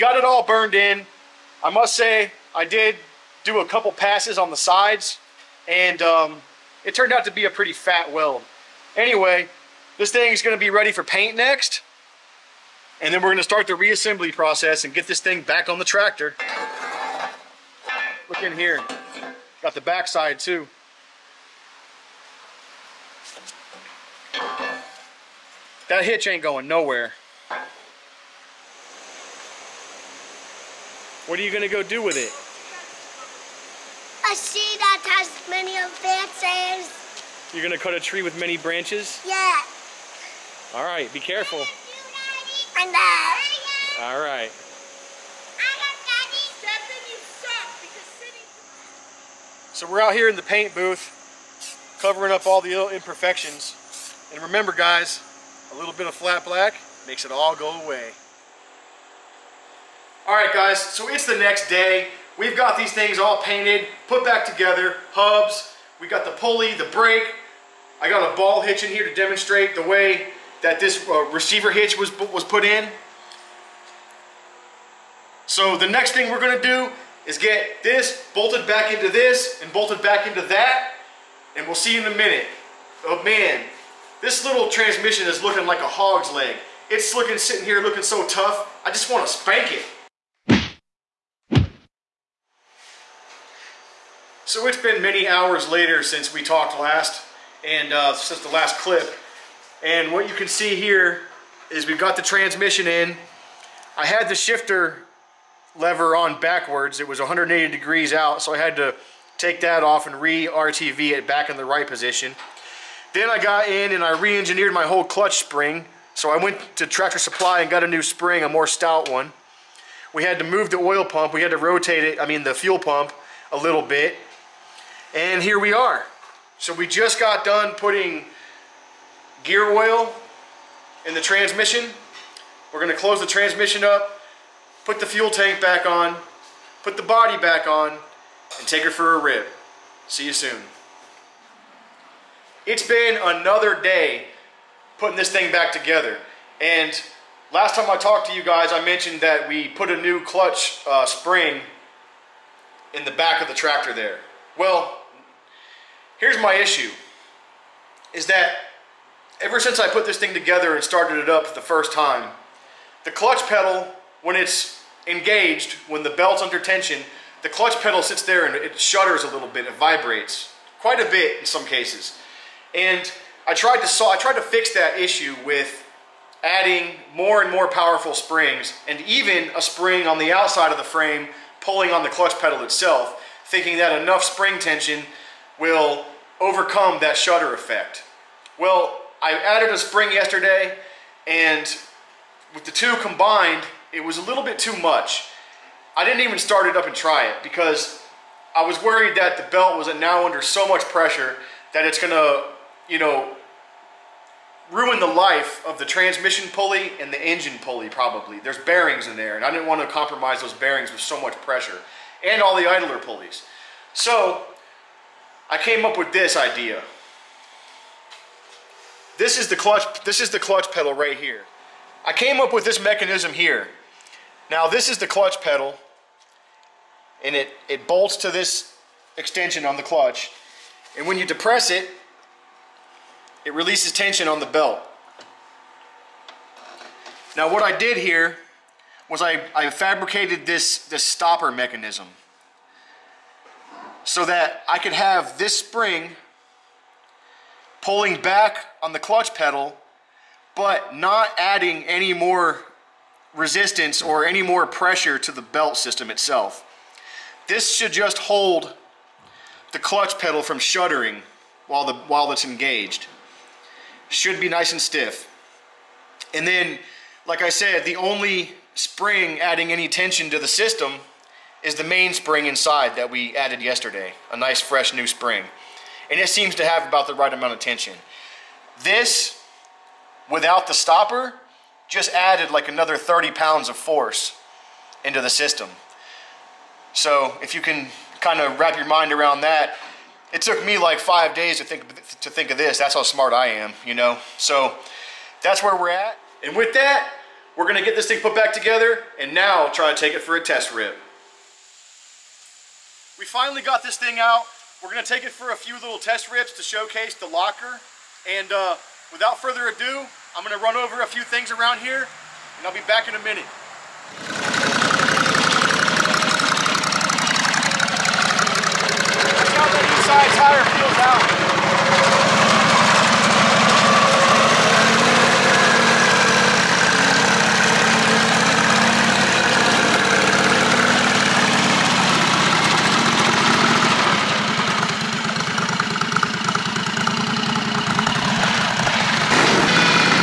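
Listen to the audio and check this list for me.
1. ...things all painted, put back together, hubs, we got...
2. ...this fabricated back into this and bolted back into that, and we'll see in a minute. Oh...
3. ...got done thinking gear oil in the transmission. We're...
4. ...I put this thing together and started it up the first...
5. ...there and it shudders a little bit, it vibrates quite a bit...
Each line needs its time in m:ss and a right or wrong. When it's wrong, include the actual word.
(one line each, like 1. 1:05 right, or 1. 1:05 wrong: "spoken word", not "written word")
1. 1:02 right
2. 1:17 wrong: "bolted", not "fabricated"
3. 2:07 wrong: "putting", not "thinking"
4. 2:39 right
5. 2:48 right.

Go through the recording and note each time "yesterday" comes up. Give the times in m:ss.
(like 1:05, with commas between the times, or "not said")
3:10, 4:33.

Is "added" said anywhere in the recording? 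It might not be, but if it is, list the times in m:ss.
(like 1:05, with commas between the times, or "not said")
3:09, 4:33, 4:42.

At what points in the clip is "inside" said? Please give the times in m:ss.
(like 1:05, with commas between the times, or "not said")
4:32, 5:19.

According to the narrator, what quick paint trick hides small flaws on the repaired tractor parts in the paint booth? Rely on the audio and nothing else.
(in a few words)
Flat black.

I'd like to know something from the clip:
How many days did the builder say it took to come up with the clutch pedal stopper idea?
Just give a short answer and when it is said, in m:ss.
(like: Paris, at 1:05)
5, at 4:50.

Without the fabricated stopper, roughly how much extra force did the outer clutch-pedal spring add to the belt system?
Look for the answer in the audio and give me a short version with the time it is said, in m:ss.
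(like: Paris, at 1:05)
30 pounds, at 4:42.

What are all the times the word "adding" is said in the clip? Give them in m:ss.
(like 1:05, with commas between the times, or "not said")
2:56, 4:11, 4:29.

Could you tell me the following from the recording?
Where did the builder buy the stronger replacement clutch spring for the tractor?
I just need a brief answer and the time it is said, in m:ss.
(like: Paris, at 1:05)
Tractor Supply, at 1:56.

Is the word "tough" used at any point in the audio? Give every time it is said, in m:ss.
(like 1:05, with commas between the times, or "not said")
1:28.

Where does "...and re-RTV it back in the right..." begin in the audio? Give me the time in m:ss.
1:50.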